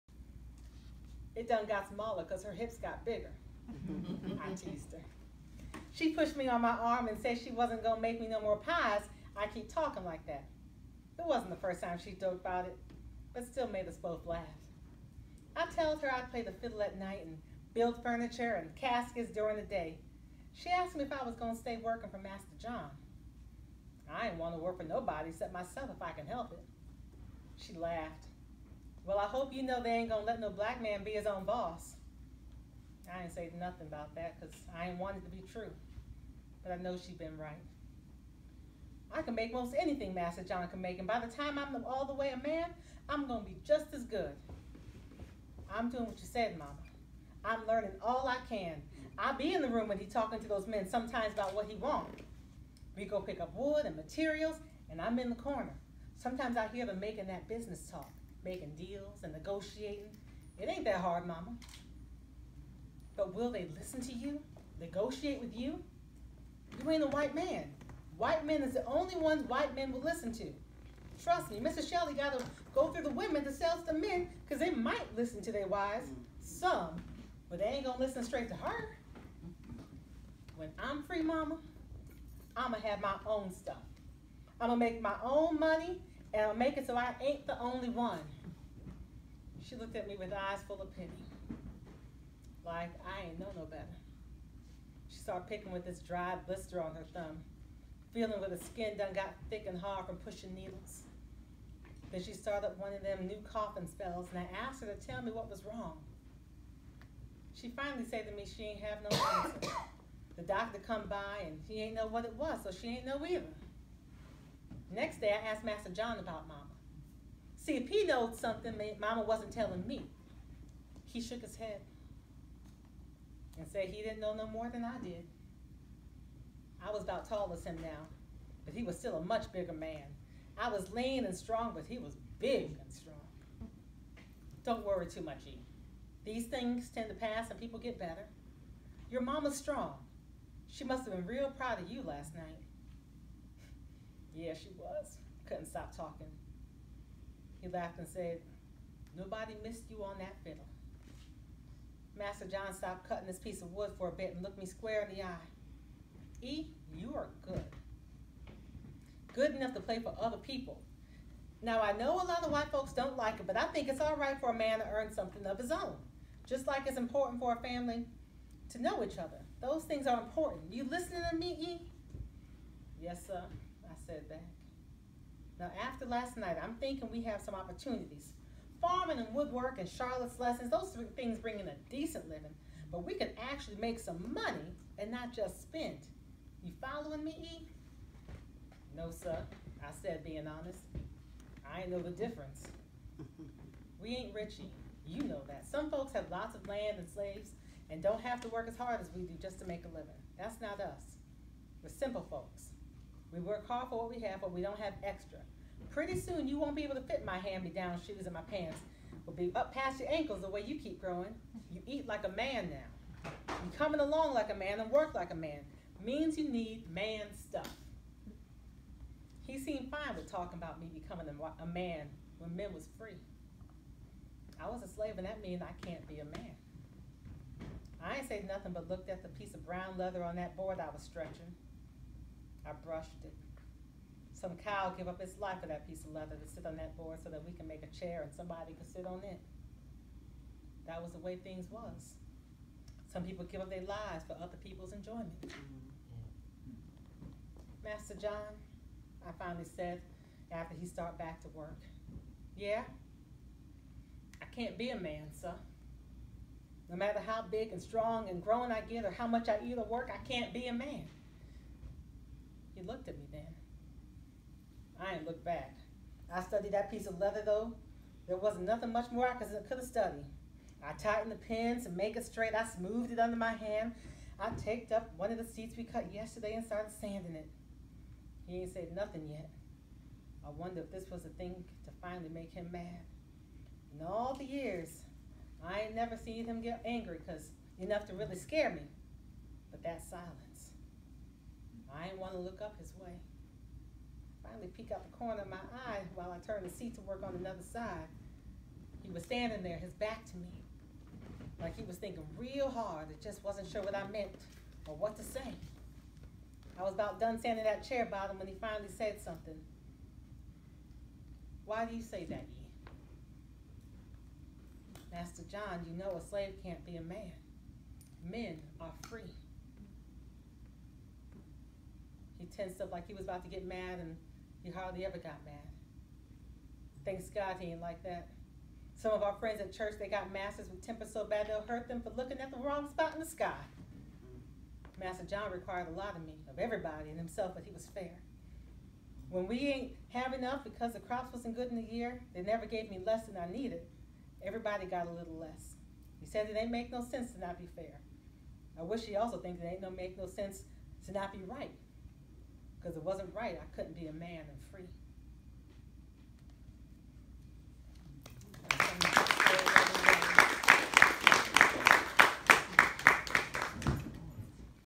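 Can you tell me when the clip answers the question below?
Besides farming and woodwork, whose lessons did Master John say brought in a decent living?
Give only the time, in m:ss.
2:59.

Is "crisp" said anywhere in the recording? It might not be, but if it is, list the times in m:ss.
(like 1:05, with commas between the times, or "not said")
not said.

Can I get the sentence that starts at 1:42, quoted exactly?
Then she started one of them new coughing spells, and I asked her to tell me what was wrong.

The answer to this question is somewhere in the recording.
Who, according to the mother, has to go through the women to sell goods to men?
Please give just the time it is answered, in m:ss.
1:11.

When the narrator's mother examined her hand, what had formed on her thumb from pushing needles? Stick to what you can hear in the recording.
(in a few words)
dry blister.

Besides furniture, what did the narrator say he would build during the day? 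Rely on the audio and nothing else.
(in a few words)
caskets.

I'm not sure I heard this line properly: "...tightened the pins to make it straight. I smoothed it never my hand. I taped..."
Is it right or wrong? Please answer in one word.
wrong.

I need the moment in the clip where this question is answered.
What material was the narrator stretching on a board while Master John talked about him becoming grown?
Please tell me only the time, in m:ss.
3:49.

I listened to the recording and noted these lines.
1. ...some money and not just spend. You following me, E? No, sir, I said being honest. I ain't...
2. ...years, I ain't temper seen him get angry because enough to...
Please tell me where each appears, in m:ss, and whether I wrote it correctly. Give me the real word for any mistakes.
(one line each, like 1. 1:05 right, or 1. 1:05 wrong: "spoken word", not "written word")
1. 3:03 right
2. 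4:44 wrong: "never", not "temper".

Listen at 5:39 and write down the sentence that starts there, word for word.
When we ain't have enough because the crops wasn't good in the year, they never gave me less than I needed.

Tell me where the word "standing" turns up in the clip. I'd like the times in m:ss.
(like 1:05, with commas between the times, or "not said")
4:59, 5:07.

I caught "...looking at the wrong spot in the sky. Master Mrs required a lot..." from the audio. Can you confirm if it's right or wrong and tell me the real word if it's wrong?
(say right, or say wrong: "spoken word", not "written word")
wrong: "John", not "Mrs".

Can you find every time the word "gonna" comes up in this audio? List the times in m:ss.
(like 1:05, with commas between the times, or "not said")
0:30, 0:43.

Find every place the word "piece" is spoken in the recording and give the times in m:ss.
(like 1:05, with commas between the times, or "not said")
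2:33, 3:49, 3:55, 4:26.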